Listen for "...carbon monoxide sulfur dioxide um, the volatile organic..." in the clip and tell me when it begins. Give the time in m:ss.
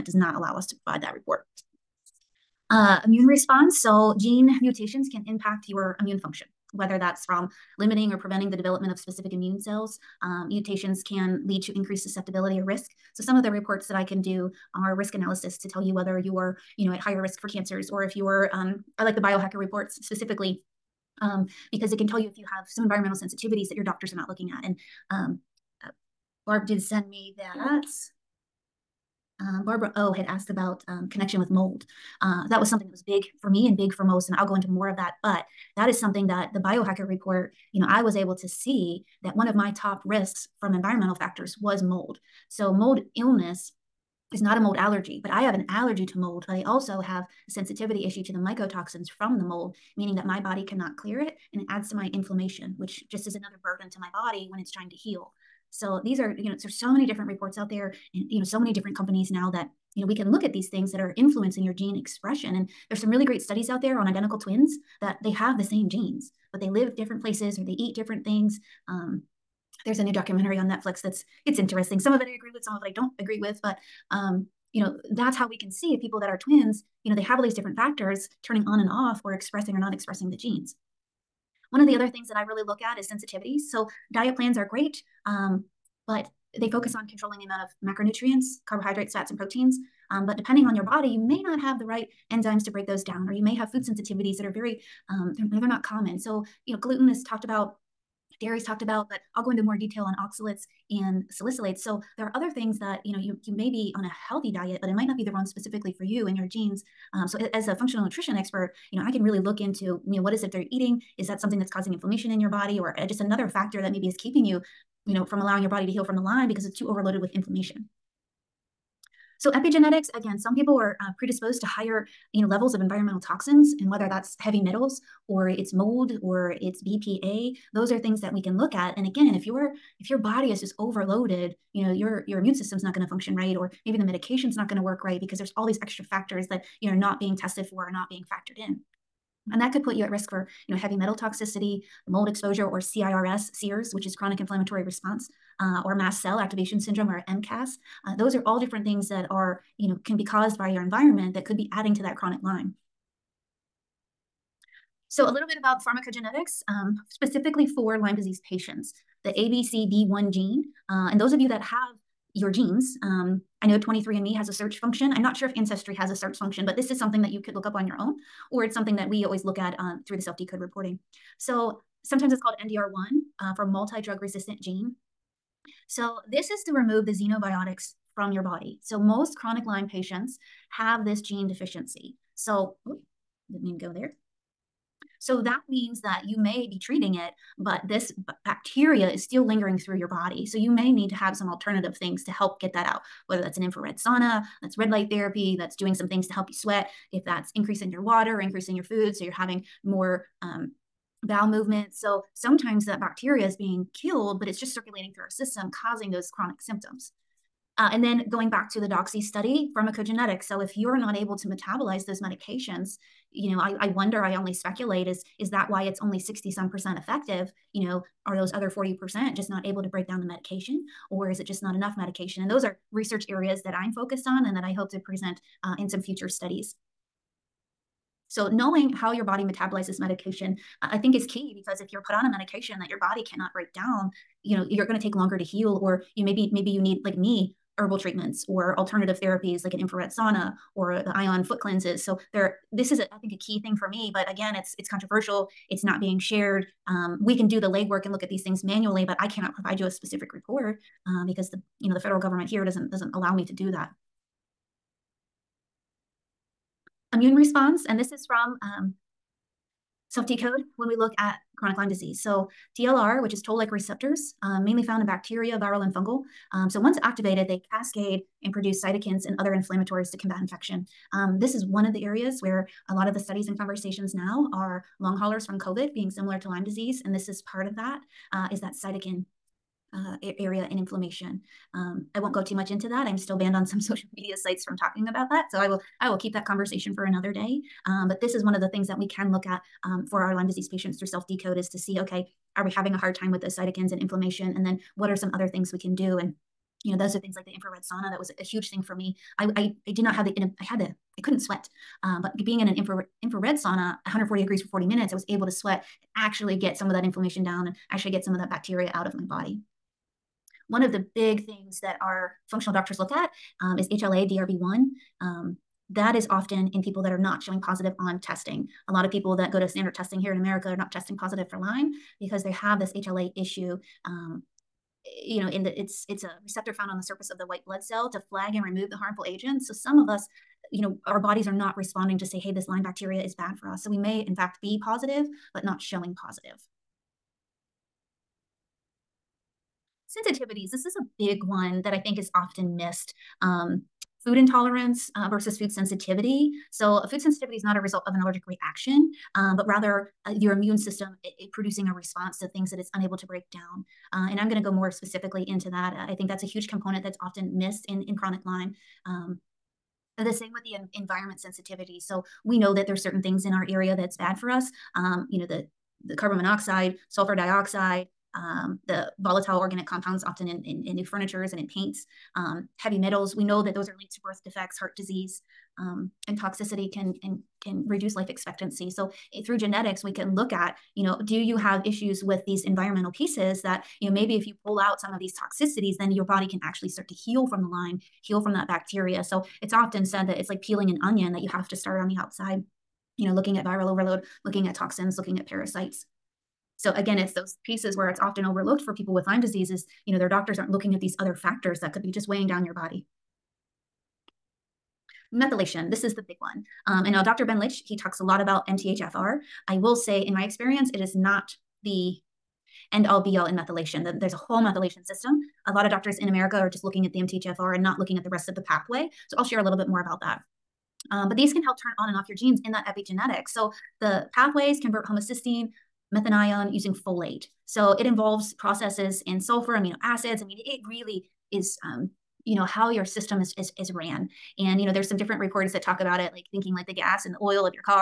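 6:06.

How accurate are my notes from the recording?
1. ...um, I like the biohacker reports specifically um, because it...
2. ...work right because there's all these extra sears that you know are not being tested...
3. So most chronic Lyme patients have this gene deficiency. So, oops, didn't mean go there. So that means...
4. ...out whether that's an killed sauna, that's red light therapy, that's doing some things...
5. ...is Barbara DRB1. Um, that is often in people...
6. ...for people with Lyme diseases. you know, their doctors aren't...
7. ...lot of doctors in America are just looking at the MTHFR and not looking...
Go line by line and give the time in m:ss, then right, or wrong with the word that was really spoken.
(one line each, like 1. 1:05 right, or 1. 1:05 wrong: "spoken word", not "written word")
1. 0:18 right
2. 2:14 wrong: "factors", not "sears"
3. 2:58 right
4. 3:12 wrong: "infrared", not "killed"
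5. 5:13 wrong: "HLA", not "Barbara"
6. 6:38 right
7. 6:55 right.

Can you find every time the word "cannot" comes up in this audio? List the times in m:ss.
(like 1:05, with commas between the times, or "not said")
0:50, 3:53, 4:09.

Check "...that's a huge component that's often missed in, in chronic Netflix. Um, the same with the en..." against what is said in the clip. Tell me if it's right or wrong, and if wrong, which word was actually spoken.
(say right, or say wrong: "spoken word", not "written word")
wrong: "Lyme", not "Netflix".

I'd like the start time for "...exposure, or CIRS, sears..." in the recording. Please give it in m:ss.
2:22.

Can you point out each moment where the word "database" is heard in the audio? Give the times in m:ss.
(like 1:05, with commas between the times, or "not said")
not said.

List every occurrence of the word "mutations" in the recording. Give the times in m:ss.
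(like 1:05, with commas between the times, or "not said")
0:04, 0:10.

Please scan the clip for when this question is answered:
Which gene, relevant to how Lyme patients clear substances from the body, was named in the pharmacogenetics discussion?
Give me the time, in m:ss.
2:39.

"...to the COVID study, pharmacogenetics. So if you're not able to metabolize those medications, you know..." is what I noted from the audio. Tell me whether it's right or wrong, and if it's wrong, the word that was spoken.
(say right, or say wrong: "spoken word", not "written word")
wrong: "DOXY", not "COVID".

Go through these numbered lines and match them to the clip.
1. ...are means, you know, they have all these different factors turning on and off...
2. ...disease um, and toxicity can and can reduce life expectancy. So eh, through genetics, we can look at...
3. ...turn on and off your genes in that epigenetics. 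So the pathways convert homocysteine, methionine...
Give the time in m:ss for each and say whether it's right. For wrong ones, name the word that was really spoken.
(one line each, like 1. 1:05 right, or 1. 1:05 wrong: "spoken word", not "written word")
1. 1:16 wrong: "twins", not "means"
2. 6:14 right
3. 7:01 right.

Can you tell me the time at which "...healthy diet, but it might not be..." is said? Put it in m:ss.
1:44.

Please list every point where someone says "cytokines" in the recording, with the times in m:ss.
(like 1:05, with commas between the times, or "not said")
4:28, 4:38, 4:53.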